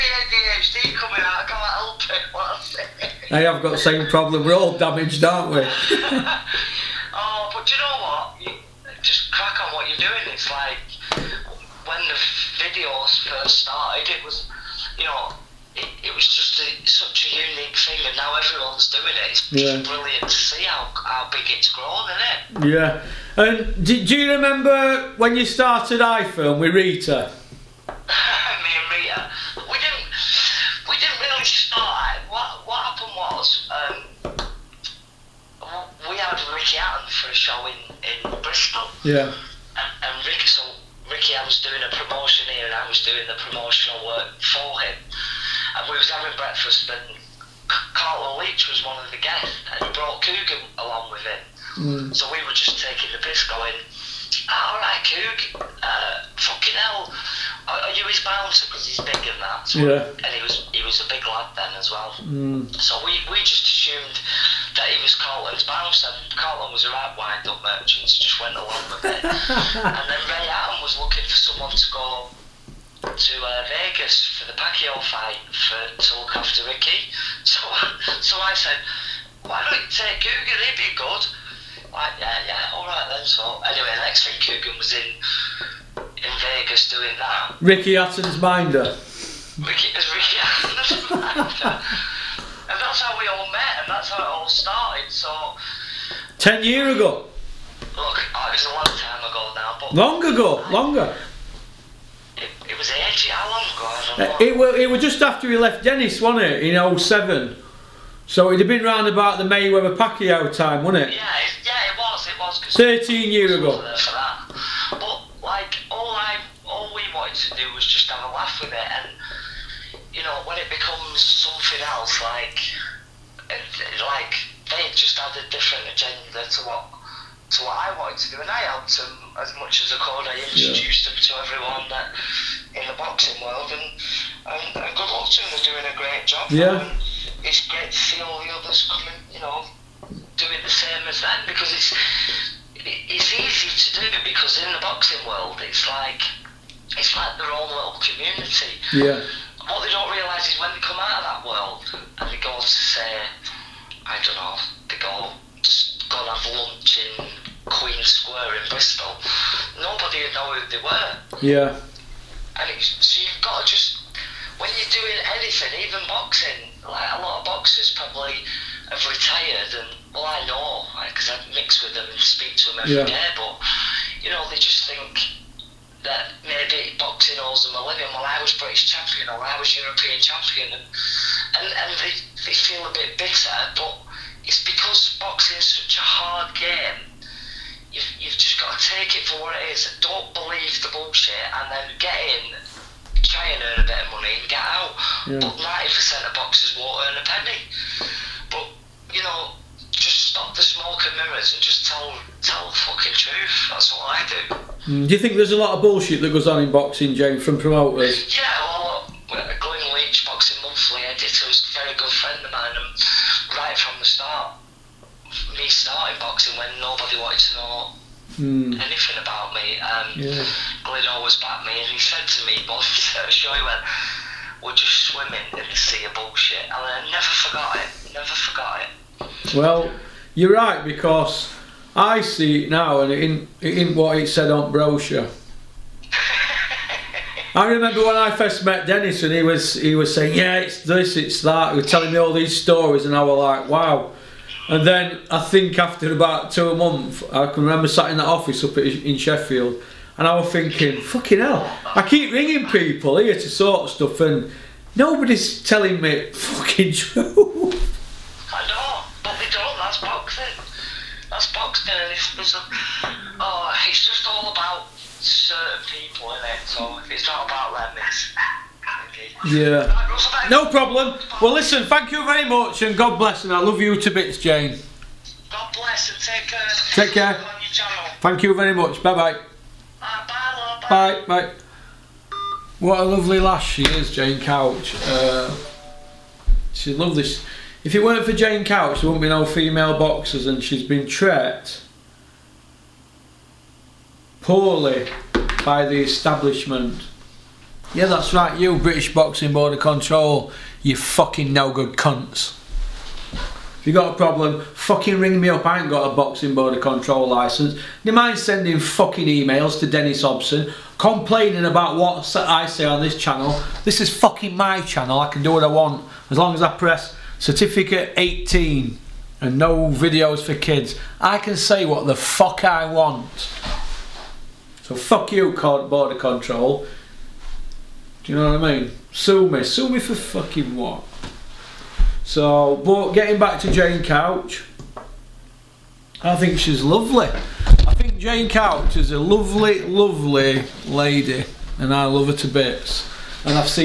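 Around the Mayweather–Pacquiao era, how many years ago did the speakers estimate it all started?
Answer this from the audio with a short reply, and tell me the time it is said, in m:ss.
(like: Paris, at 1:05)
13, at 1:52.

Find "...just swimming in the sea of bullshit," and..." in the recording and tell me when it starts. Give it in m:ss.
3:44.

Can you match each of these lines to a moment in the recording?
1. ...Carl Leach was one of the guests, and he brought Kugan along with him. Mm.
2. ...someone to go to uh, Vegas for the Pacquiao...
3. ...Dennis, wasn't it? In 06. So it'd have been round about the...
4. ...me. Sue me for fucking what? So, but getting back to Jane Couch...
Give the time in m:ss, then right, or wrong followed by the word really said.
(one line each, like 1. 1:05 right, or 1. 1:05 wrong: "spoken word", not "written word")
1. 0:47 right
2. 1:11 right
3. 1:45 wrong: "07", not "06"
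4. 5:29 right.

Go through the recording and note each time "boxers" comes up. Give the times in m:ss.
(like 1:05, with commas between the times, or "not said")
2:47, 3:16, 4:49.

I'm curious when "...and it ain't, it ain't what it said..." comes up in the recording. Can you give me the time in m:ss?
3:53.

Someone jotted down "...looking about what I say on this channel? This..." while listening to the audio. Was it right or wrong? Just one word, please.
wrong.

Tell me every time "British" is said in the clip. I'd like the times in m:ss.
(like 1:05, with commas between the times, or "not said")
2:58, 4:58.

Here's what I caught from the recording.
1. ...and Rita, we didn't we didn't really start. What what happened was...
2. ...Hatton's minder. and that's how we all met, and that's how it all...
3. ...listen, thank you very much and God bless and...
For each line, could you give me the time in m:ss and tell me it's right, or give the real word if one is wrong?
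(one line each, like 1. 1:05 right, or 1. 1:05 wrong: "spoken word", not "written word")
1. 0:28 right
2. 1:30 right
3. 4:31 right.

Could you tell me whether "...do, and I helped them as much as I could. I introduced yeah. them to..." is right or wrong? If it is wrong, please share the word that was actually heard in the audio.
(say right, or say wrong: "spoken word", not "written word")
right.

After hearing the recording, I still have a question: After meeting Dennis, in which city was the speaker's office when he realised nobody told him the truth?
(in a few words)
Sheffield.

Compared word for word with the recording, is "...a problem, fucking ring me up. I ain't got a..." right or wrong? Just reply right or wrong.
right.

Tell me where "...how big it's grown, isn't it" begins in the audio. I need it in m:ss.
0:21.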